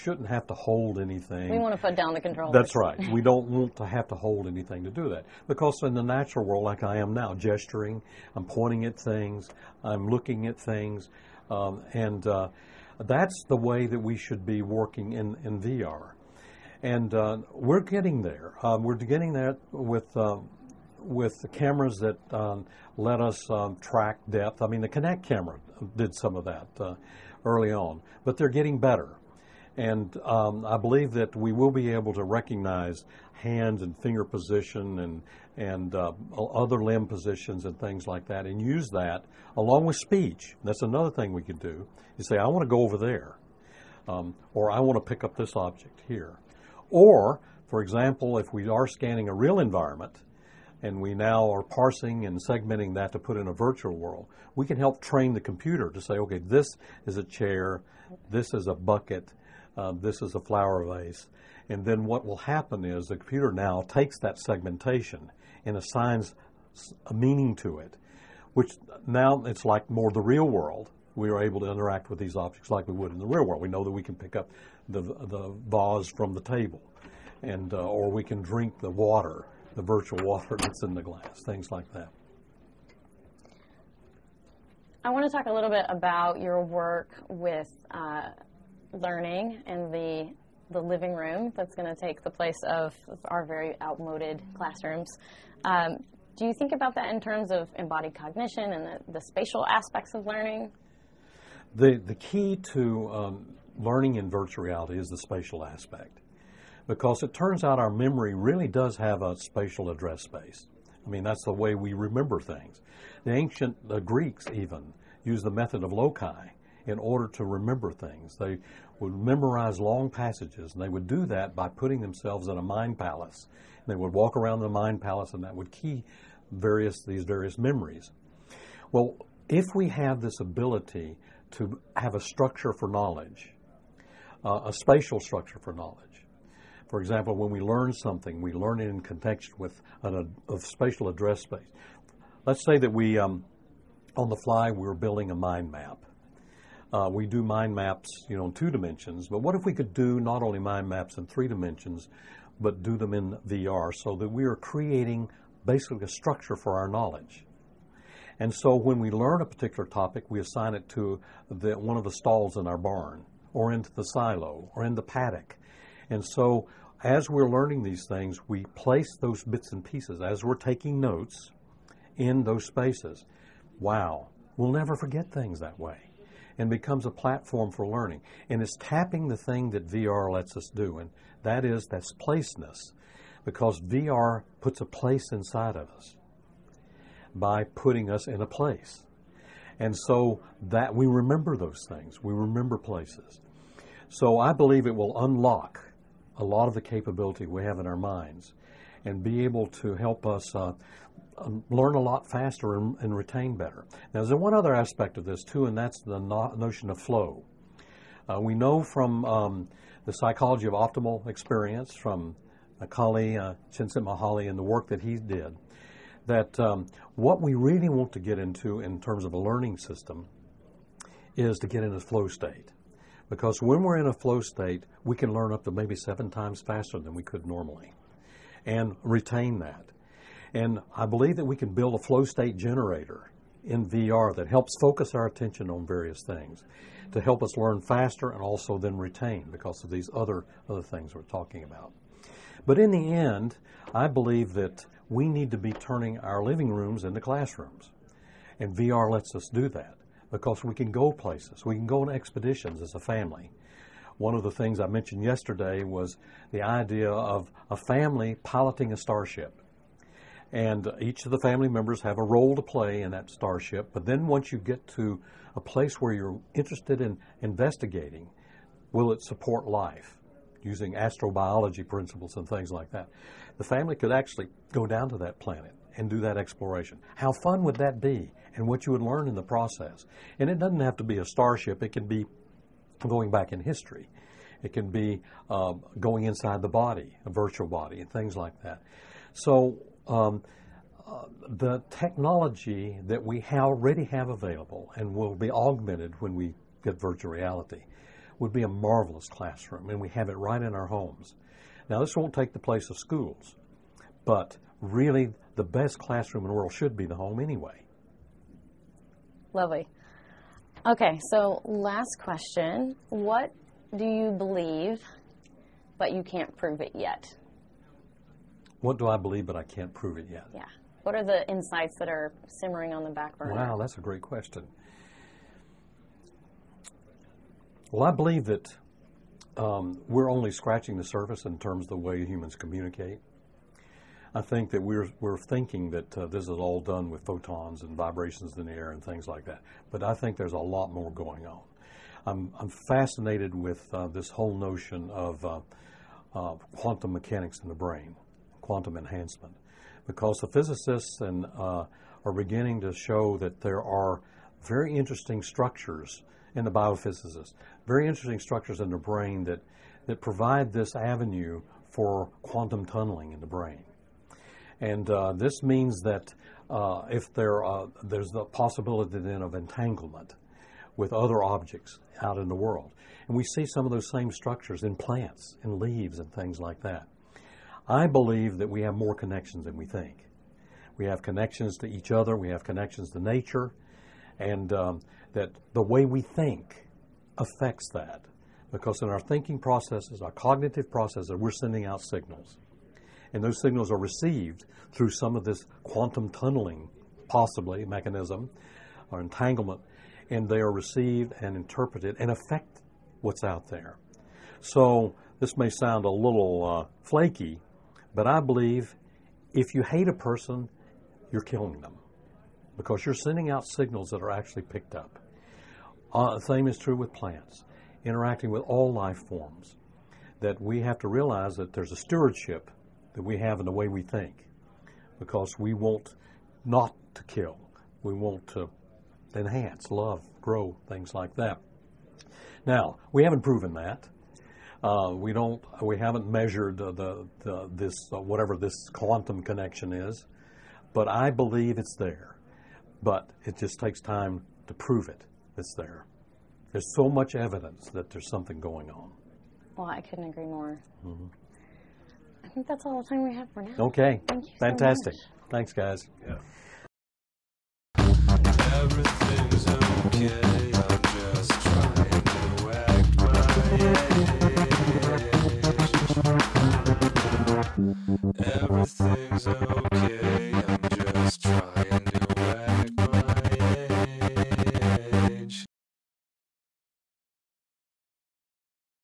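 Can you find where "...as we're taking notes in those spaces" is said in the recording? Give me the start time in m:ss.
2:50.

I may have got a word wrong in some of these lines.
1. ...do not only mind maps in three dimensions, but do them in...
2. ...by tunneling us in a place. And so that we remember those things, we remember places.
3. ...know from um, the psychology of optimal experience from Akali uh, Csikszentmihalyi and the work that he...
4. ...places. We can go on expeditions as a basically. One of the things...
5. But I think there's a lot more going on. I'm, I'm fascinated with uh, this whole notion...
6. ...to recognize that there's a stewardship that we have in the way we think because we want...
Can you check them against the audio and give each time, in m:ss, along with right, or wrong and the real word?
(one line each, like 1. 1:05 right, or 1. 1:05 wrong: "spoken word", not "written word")
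1. 2:29 right
2. 3:07 wrong: "putting", not "tunneling"
3. 3:28 right
4. 4:11 wrong: "family", not "basically"
5. 5:39 right
6. 7:00 wrong: "realize", not "recognize".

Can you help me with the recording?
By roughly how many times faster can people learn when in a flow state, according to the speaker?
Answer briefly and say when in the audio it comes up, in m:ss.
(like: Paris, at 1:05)
7, at 3:45.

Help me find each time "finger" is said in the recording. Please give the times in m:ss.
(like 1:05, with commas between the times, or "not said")
0:34.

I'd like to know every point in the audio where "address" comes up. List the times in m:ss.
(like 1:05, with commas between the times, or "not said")
1:49, 2:21.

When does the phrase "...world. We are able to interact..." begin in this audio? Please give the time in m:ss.
1:10.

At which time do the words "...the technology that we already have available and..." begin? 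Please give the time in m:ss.
4:51.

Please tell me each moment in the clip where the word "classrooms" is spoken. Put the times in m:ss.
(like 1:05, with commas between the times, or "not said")
1:34, 4:07, 4:59, 5:05.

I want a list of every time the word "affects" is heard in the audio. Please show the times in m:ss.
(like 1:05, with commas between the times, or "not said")
6:27, 6:42.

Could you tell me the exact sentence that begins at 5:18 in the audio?
What do I believe, but I can't prove it yet?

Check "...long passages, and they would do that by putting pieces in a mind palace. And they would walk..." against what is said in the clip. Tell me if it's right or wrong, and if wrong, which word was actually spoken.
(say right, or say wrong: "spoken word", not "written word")
wrong: "themselves", not "pieces".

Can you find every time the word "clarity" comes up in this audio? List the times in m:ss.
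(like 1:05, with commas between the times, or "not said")
not said.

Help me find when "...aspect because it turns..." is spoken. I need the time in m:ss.
1:45.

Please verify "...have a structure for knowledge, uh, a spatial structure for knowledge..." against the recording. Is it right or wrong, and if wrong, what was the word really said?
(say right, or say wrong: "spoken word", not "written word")
right.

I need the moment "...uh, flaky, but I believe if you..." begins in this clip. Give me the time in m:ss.
6:46.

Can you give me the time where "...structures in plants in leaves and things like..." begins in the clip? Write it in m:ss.
6:14.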